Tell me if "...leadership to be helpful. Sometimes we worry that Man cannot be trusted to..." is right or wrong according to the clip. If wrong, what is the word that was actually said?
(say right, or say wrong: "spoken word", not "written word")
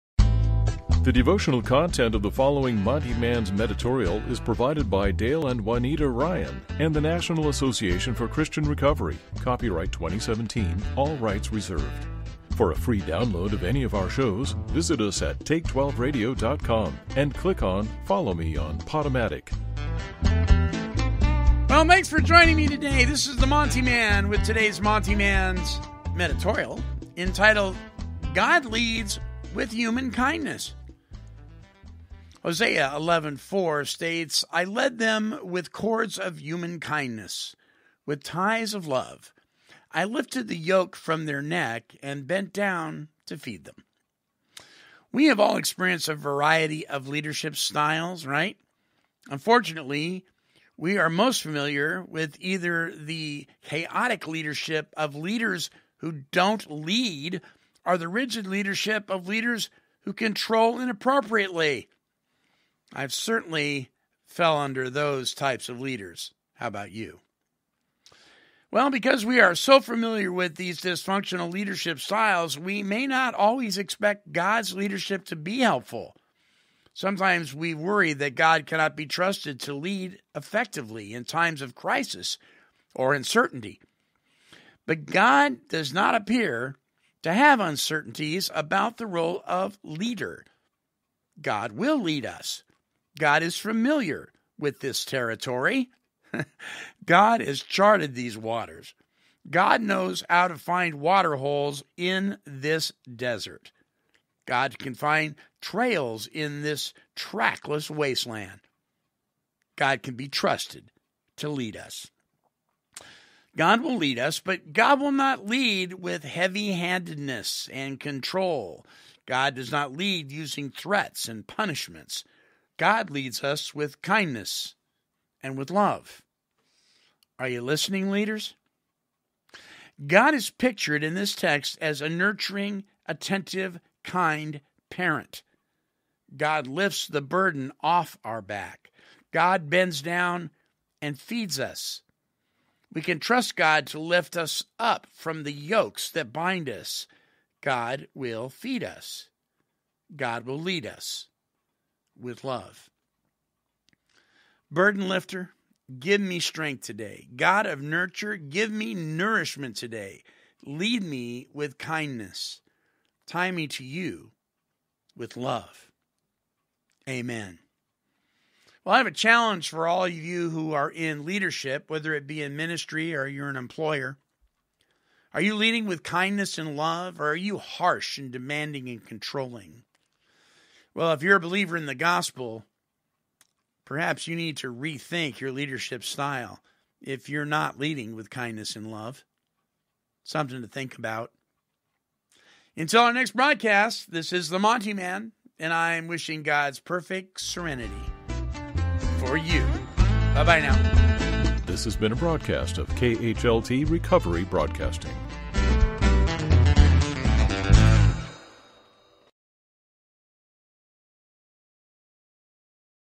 wrong: "God", not "Man".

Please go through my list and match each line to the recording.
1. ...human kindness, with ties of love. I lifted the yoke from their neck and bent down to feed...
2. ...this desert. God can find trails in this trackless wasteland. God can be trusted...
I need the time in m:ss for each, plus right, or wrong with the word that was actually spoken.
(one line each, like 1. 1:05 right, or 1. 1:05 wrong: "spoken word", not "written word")
1. 0:36 right
2. 1:42 right.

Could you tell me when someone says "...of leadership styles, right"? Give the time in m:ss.
0:46.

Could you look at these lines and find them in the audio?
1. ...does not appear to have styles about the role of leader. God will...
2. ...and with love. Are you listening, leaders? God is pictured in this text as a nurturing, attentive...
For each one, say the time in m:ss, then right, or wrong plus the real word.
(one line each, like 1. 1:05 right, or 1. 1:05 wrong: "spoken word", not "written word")
1. 1:25 wrong: "uncertainties", not "styles"
2. 2:05 right.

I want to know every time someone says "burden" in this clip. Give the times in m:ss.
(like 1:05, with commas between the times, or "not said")
2:17, 2:34.